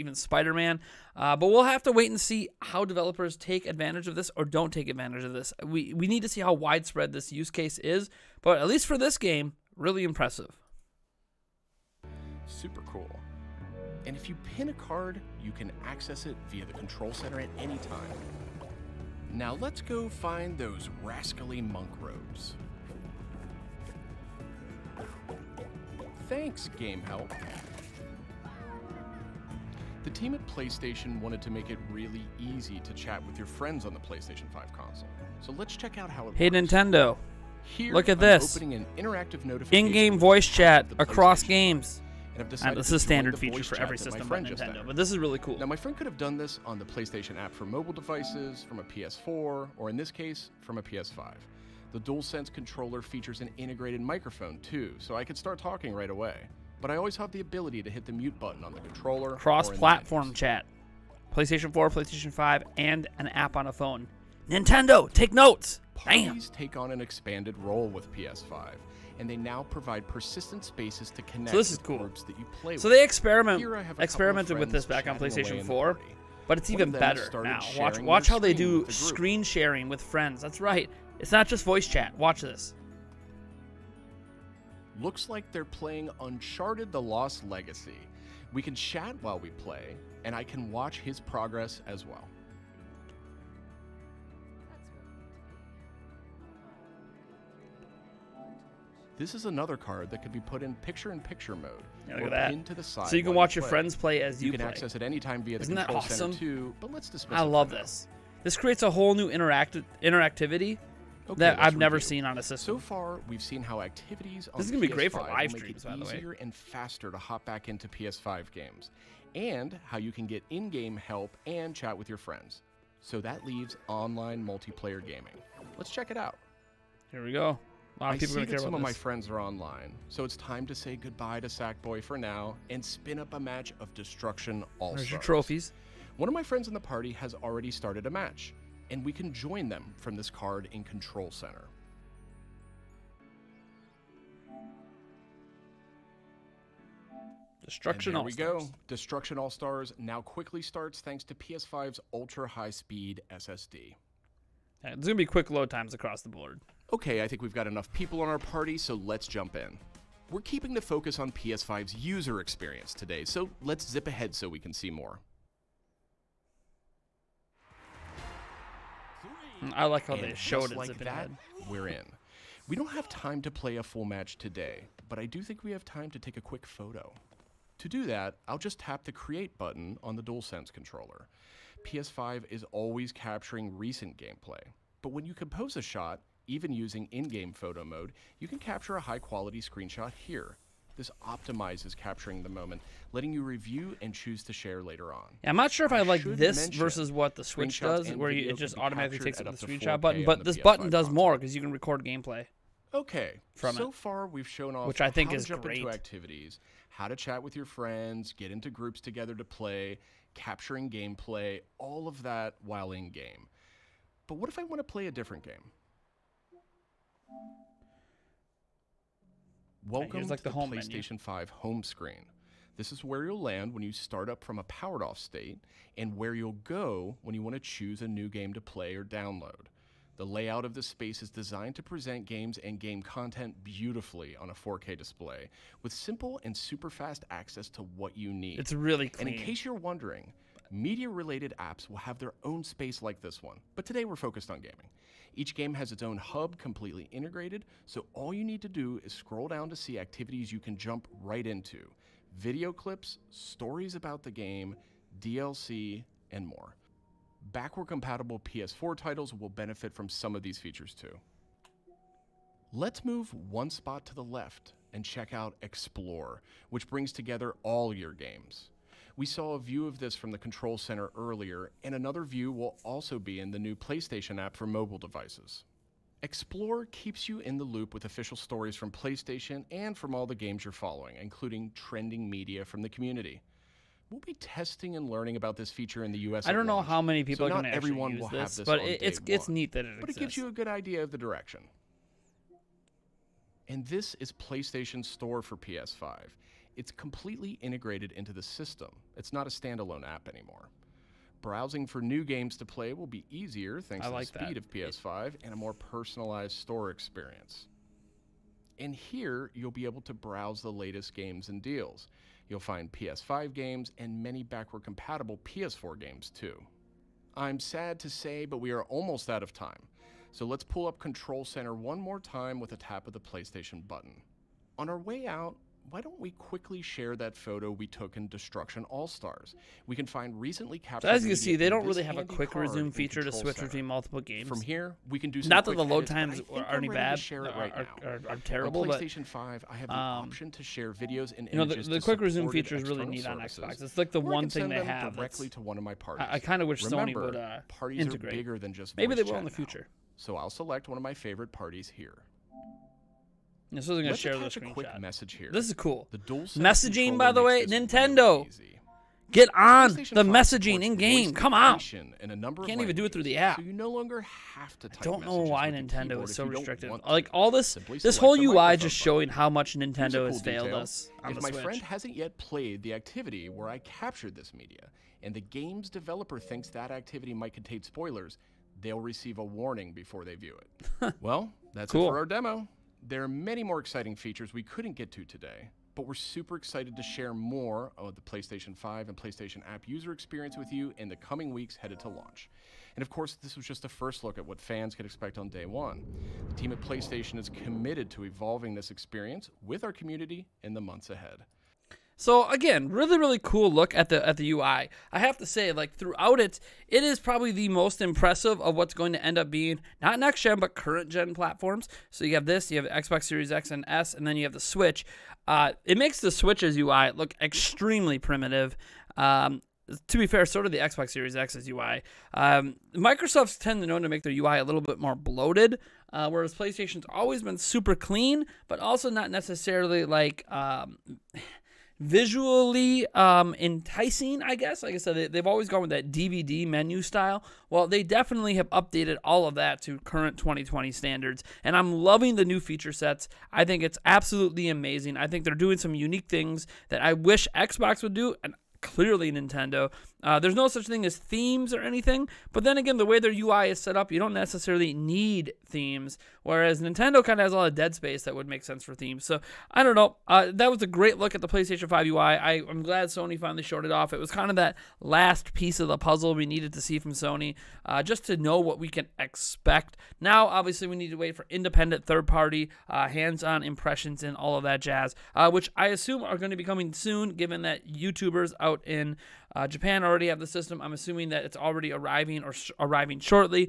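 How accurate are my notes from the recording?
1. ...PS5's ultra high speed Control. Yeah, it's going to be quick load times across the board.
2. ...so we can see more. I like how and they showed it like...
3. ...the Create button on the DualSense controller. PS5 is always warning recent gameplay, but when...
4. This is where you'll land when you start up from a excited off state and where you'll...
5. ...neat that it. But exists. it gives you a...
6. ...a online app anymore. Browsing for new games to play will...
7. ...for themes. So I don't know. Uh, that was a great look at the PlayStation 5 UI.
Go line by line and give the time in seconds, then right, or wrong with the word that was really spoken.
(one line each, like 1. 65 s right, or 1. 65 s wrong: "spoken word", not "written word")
1. 151 s wrong: "SSD", not "Control"
2. 164 s right
3. 179 s wrong: "capturing", not "warning"
4. 222 s wrong: "powered", not "excited"
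5. 289 s right
6. 299 s wrong: "standalone", not "online"
7. 458 s right.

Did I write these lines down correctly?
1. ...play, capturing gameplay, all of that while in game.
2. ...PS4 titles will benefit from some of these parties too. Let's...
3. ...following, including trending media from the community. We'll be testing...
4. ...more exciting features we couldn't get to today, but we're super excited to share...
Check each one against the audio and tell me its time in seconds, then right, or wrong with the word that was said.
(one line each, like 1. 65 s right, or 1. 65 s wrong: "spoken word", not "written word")
1. 209 s right
2. 258 s wrong: "features", not "parties"
3. 280 s right
4. 383 s right.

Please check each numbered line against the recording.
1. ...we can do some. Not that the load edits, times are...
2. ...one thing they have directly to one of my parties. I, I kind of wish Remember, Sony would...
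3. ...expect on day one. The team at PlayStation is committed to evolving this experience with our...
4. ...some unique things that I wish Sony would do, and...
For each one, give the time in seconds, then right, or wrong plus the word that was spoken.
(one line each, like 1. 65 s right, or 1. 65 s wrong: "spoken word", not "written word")
1. 335 s right
2. 344 s right
3. 395 s right
4. 445 s wrong: "Xbox", not "Sony".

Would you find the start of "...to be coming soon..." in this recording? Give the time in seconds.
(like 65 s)
476 s.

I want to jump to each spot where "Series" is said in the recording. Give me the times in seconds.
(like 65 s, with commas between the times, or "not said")
413 s, 421 s.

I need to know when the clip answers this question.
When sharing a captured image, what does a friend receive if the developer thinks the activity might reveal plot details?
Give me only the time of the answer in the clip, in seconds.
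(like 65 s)
378 s.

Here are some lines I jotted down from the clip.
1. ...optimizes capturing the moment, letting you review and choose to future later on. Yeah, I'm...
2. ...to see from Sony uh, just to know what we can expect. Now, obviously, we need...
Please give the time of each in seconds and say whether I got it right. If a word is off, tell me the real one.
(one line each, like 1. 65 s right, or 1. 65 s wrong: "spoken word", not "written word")
1. 191 s wrong: "share", not "future"
2. 466 s right.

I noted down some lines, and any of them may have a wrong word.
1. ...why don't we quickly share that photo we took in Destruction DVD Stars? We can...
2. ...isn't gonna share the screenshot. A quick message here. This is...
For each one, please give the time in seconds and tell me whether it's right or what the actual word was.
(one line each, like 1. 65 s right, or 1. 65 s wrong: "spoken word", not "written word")
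1. 325 s wrong: "All", not "DVD"
2. 353 s right.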